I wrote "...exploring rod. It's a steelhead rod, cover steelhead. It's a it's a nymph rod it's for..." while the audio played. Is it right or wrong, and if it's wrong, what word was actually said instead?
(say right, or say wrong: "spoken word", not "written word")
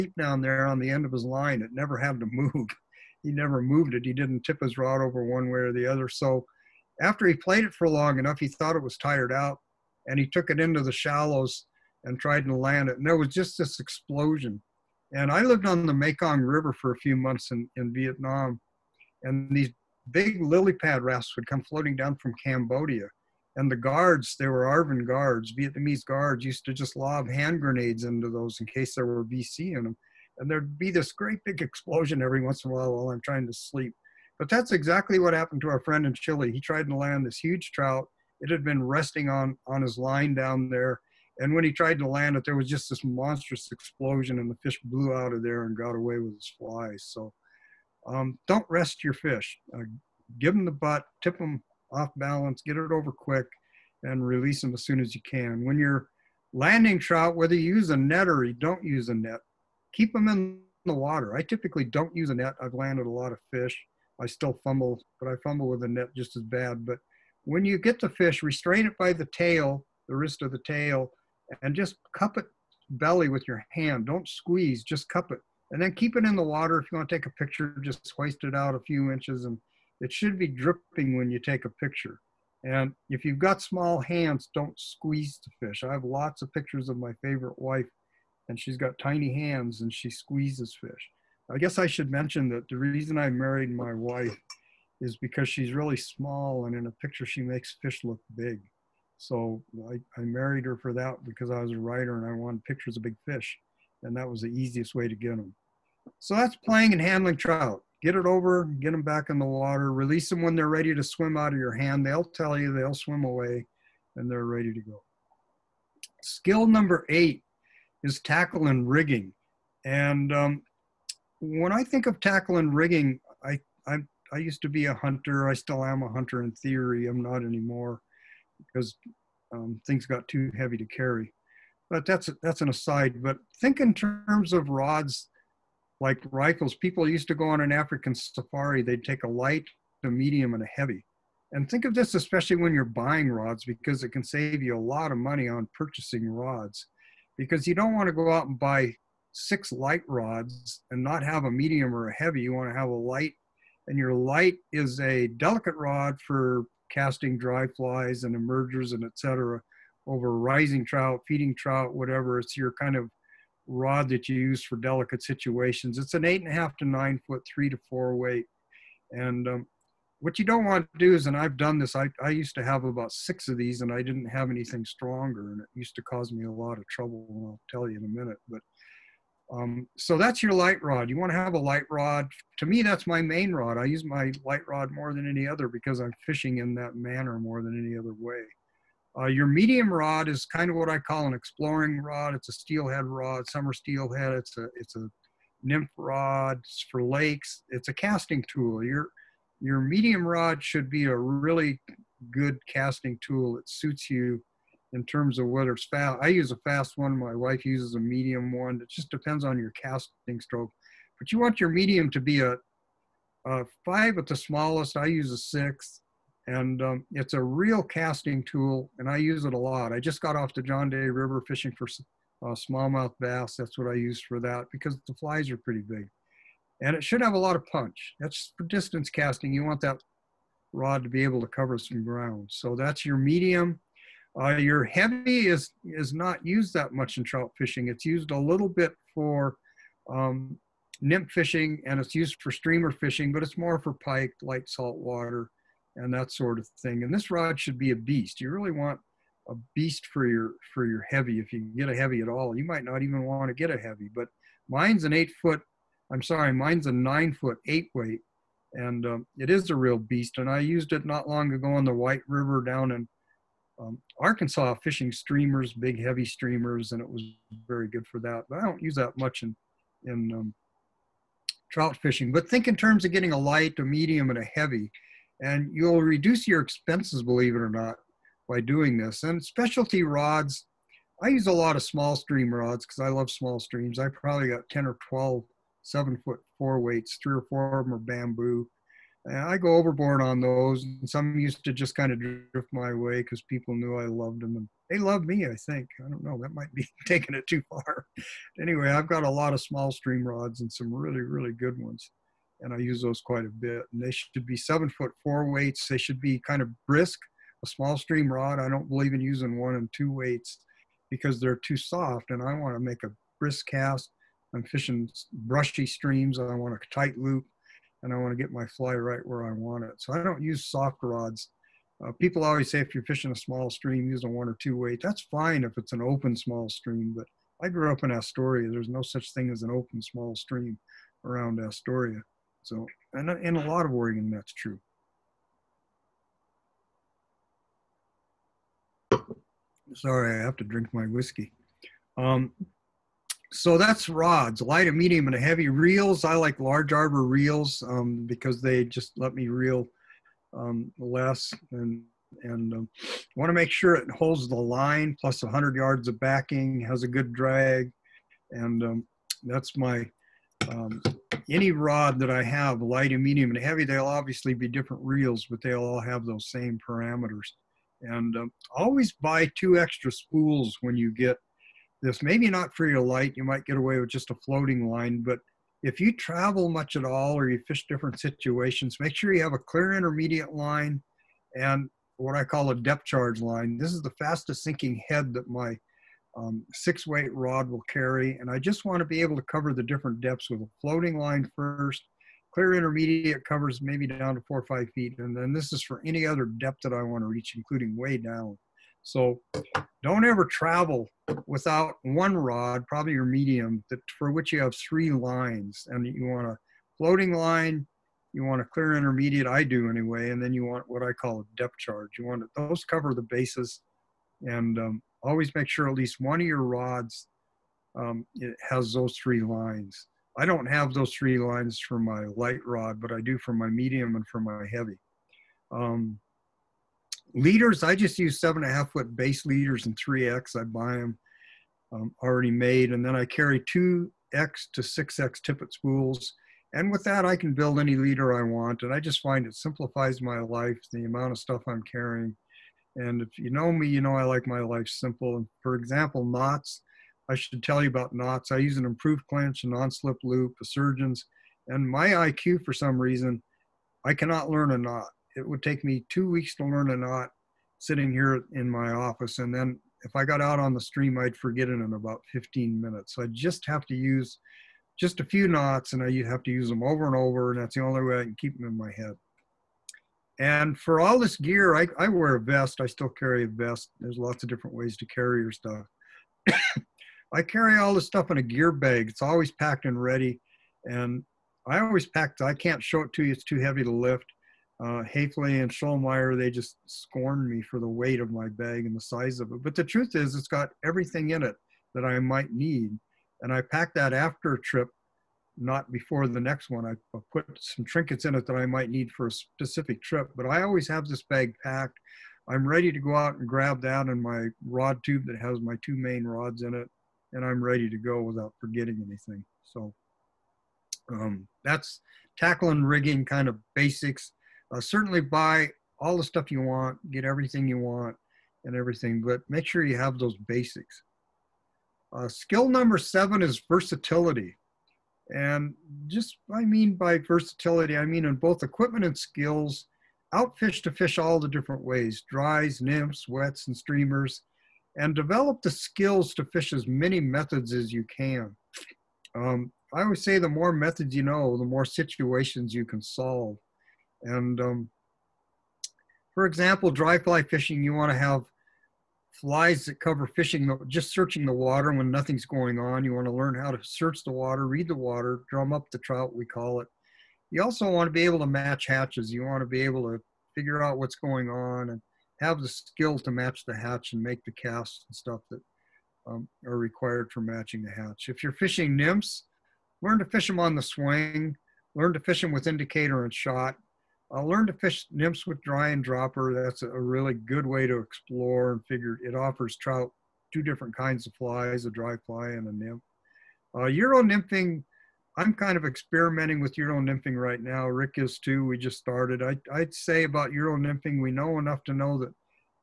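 wrong: "summer", not "cover".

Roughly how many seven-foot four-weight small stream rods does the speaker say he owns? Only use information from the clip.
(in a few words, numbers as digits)
10 or 12.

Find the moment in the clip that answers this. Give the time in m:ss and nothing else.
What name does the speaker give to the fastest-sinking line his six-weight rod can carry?
6:22.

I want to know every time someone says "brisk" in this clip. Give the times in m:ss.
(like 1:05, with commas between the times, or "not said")
5:06, 5:13.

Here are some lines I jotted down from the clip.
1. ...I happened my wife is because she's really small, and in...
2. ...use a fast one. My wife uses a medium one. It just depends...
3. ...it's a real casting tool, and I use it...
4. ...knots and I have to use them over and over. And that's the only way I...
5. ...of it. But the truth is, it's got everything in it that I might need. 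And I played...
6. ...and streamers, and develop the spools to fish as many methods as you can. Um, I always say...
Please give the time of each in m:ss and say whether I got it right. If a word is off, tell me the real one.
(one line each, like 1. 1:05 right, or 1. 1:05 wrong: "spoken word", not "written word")
1. 1:33 wrong: "married", not "happened"
2. 3:26 right
3. 3:37 right
4. 7:45 right
5. 8:09 wrong: "packed", not "played"
6. 8:53 wrong: "skills", not "spools".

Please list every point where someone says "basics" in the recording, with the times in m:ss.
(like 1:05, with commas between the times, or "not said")
8:33, 8:40.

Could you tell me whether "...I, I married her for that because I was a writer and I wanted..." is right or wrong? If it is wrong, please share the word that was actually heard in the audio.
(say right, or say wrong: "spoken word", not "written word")
right.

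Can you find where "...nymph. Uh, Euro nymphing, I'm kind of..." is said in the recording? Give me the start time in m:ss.
9:42.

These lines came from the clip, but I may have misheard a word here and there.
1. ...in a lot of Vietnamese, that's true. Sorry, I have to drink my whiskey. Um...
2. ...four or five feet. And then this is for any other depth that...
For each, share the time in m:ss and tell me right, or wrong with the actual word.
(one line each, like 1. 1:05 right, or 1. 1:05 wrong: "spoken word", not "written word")
1. 5:33 wrong: "Oregon", not "Vietnamese"
2. 6:34 right.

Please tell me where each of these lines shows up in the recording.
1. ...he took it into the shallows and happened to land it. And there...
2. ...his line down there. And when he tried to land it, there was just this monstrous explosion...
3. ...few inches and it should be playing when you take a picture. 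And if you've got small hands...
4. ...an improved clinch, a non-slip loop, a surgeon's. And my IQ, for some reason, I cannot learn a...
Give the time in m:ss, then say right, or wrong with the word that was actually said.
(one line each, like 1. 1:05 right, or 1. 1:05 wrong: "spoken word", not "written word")
1. 0:10 wrong: "tried", not "happened"
2. 0:39 right
3. 1:18 wrong: "dripping", not "playing"
4. 7:28 right.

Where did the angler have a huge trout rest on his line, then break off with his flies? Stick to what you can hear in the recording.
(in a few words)
Chile.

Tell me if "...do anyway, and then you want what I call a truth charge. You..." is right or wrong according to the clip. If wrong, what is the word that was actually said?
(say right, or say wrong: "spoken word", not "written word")
wrong: "depth", not "truth".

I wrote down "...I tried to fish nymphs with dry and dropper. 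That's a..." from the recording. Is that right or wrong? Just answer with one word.
wrong.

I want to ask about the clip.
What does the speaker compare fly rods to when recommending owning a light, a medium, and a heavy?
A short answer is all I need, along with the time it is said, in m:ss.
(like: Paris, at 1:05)
Rifles, at 2:16.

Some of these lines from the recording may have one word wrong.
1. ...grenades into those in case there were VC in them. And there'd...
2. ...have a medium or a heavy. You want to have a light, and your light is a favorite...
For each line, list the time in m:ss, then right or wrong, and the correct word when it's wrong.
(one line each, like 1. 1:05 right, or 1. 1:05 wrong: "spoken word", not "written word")
1. 0:27 right
2. 2:31 wrong: "delicate", not "favorite".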